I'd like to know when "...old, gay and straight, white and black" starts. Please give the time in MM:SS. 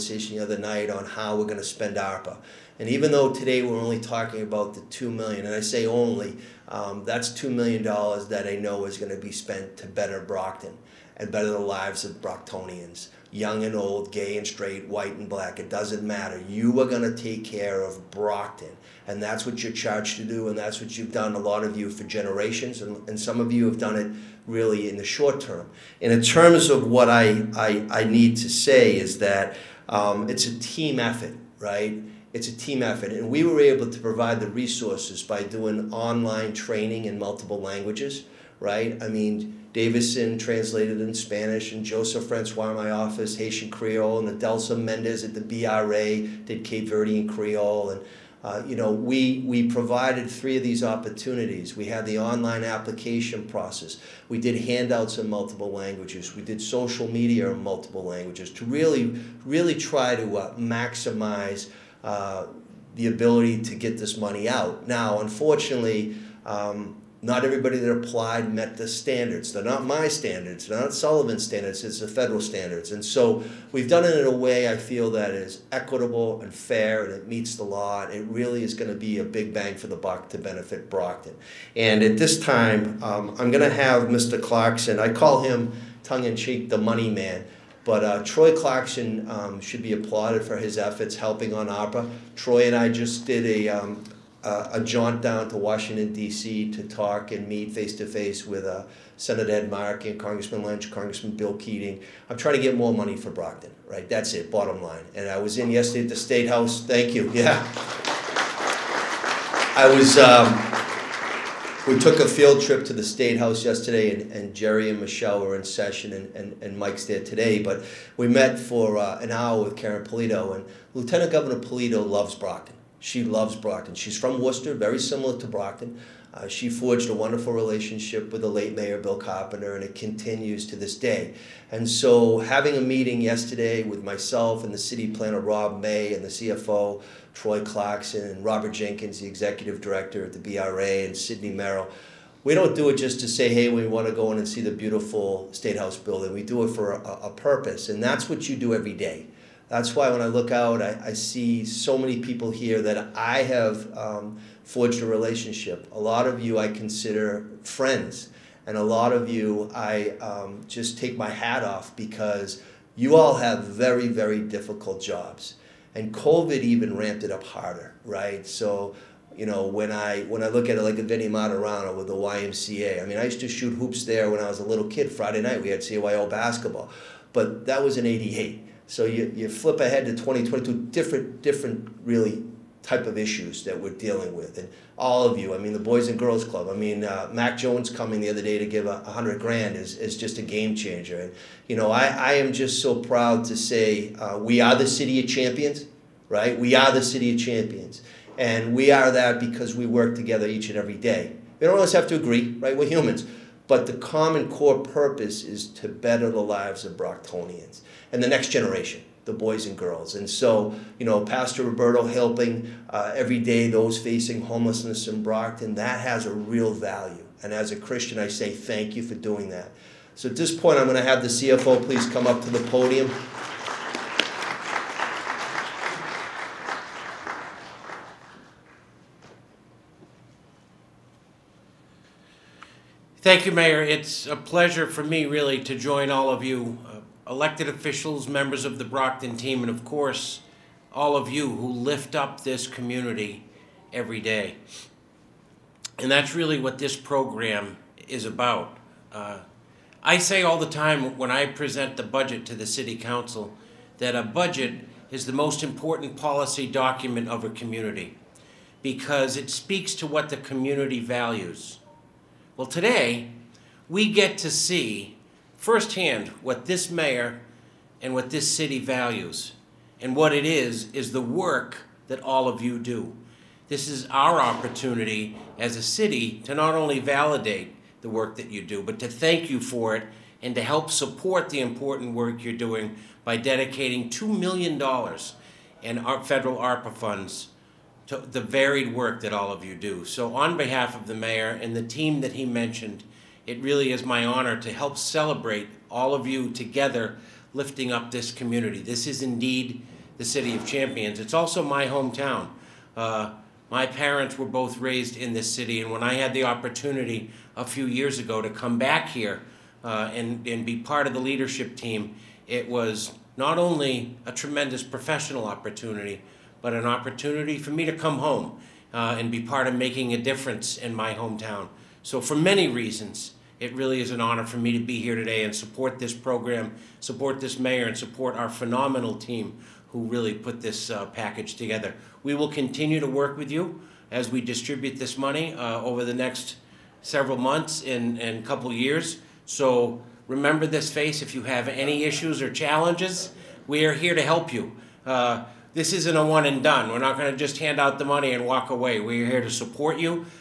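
00:13.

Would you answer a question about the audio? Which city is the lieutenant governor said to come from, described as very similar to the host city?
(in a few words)
Worcester.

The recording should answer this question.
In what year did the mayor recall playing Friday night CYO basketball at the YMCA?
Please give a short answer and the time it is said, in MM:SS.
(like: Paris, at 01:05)
1988, at 02:58.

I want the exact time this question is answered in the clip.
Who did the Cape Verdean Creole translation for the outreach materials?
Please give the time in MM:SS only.
00:44.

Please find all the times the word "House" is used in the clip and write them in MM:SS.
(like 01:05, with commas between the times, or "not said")
01:46, 01:53, 02:25.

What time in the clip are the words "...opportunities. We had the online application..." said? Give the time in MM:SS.
00:50.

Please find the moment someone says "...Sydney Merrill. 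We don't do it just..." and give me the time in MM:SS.
02:21.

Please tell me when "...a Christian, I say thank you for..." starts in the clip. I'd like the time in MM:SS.
03:37.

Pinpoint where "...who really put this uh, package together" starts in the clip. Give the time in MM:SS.
05:29.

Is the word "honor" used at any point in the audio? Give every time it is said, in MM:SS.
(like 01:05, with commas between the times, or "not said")
04:54, 05:24.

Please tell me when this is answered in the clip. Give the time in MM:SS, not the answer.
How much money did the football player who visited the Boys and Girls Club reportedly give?
03:09.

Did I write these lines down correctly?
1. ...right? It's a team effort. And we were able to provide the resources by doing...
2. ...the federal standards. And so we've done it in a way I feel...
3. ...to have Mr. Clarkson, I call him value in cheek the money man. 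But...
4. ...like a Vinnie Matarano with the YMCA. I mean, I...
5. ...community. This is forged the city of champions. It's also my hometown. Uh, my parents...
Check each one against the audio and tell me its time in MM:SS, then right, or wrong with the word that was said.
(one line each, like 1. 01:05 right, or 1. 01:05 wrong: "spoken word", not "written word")
1. 00:31 right
2. 01:11 right
3. 01:23 wrong: "tongue", not "value"
4. 02:50 right
5. 04:58 wrong: "indeed", not "forged".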